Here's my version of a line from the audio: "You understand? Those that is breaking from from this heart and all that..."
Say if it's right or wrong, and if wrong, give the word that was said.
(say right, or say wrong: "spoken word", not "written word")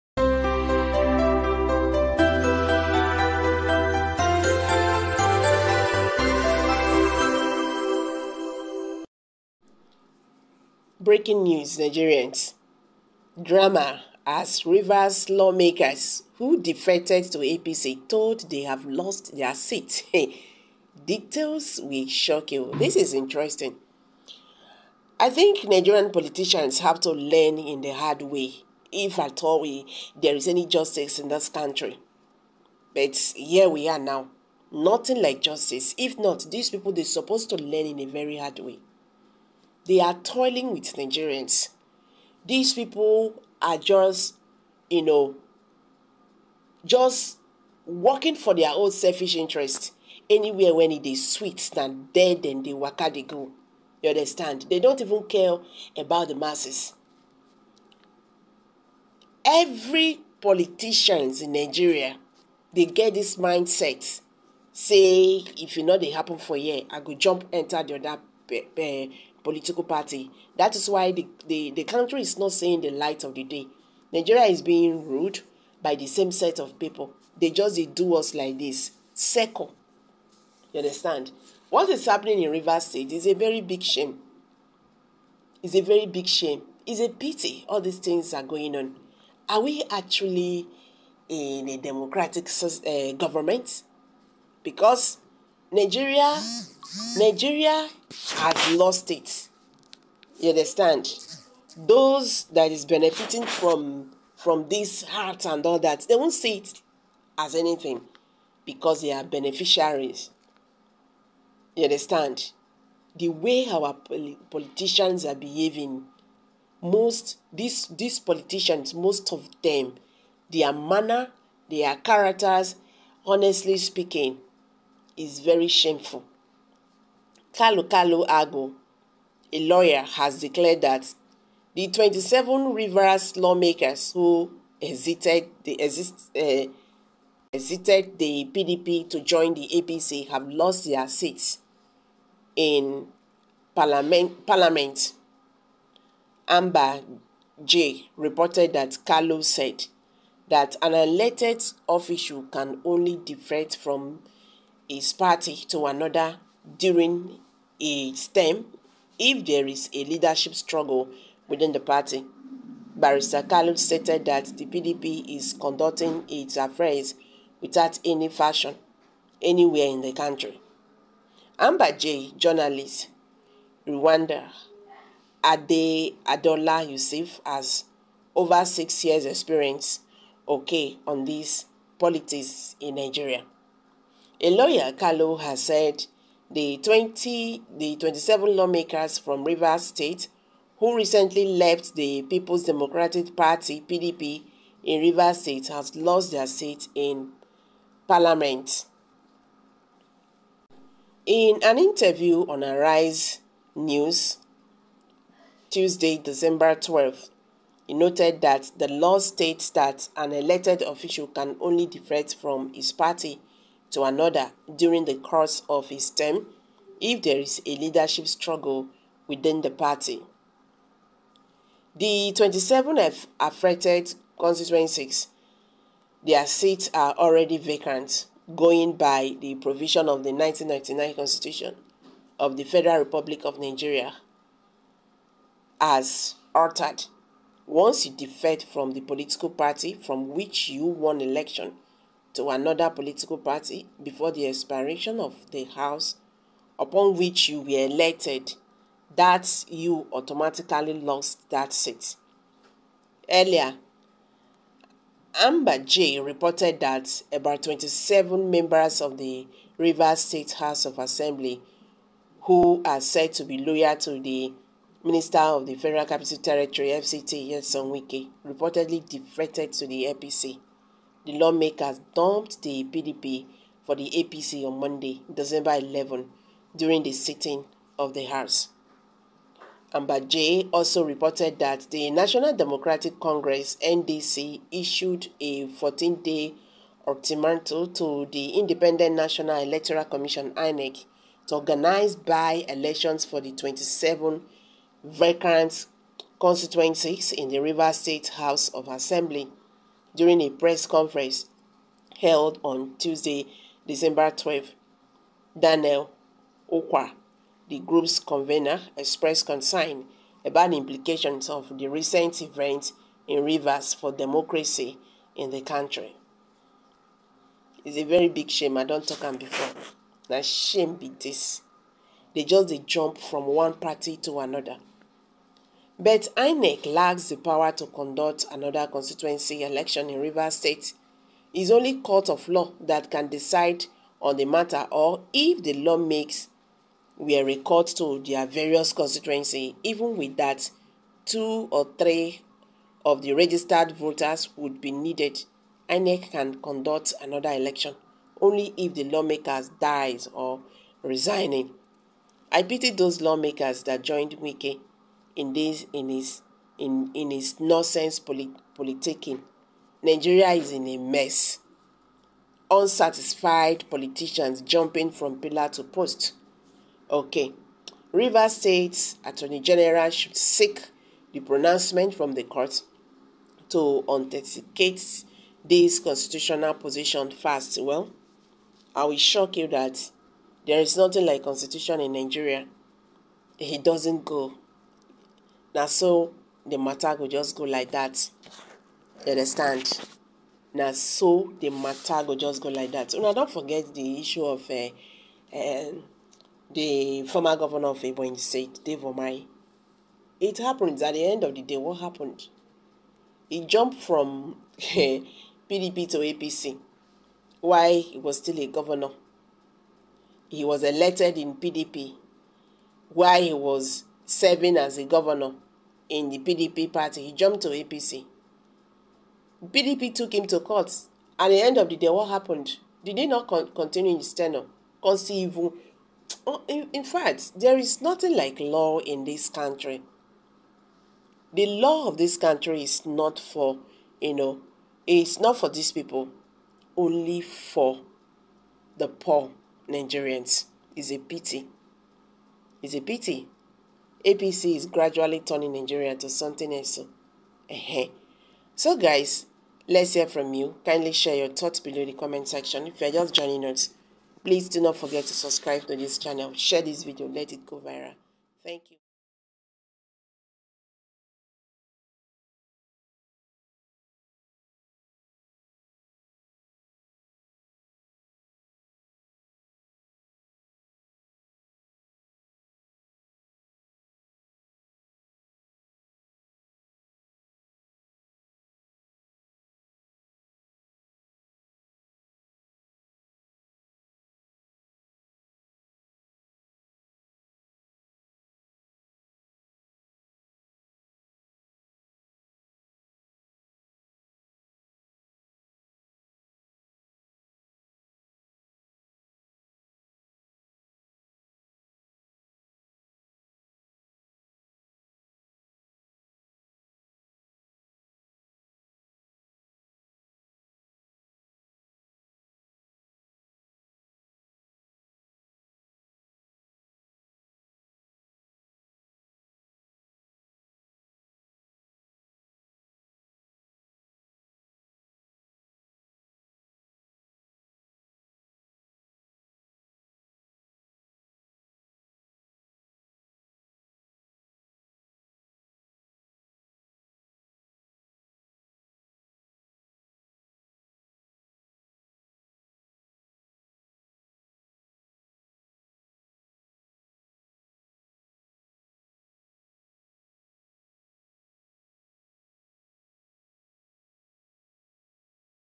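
wrong: "benefiting", not "breaking".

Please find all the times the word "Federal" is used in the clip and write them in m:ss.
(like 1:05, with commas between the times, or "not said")
3:52, 4:25.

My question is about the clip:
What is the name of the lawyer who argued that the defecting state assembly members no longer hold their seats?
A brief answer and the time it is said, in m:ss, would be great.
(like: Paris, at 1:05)
Kalu Kalu Ago, at 2:07.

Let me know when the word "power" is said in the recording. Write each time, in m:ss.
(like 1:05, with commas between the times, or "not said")
5:27.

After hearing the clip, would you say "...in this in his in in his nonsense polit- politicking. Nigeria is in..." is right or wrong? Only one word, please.
right.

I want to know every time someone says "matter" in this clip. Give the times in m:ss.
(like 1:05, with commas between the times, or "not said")
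5:34, 6:26, 6:31.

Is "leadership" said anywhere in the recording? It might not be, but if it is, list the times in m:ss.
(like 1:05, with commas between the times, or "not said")
2:40, 3:37.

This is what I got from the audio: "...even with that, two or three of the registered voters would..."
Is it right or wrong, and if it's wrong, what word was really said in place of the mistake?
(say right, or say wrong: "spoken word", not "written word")
right.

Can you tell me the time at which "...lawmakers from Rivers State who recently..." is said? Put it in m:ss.
3:08.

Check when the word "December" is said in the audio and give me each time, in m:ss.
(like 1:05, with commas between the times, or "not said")
3:26, 4:35, 5:03.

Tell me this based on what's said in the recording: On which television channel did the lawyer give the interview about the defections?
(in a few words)
Arise News.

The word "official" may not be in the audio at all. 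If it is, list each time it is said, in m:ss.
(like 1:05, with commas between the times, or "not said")
2:31, 3:30.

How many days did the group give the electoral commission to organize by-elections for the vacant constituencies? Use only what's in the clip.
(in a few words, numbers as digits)
14.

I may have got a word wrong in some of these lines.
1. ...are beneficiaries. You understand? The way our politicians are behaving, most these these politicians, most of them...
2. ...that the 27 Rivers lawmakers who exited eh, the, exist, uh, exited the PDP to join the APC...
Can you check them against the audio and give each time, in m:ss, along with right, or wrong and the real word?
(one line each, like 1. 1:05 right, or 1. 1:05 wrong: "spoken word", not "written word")
1. 1:49 right
2. 2:10 right.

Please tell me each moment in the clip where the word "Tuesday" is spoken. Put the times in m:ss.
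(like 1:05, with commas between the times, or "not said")
3:25, 5:02.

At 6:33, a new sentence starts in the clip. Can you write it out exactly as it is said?
So now, don't forget the issue of uh, uh, the former governor of Ebonyi State, Dave Umahi.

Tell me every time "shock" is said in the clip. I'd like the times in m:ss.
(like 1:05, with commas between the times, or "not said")
0:22, 6:19.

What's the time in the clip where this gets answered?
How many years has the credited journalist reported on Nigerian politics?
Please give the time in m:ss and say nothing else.
2:58.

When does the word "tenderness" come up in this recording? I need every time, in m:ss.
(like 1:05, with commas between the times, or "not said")
not said.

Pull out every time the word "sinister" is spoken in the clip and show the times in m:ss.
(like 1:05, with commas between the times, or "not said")
not said.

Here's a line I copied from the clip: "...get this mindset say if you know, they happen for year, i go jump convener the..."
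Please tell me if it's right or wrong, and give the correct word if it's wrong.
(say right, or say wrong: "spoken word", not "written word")
wrong: "enter", not "convener".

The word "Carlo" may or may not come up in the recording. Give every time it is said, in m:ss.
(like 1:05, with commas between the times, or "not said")
2:29, 3:04.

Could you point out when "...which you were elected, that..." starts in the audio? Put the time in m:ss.
4:07.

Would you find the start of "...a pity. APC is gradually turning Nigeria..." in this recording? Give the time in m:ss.
7:22.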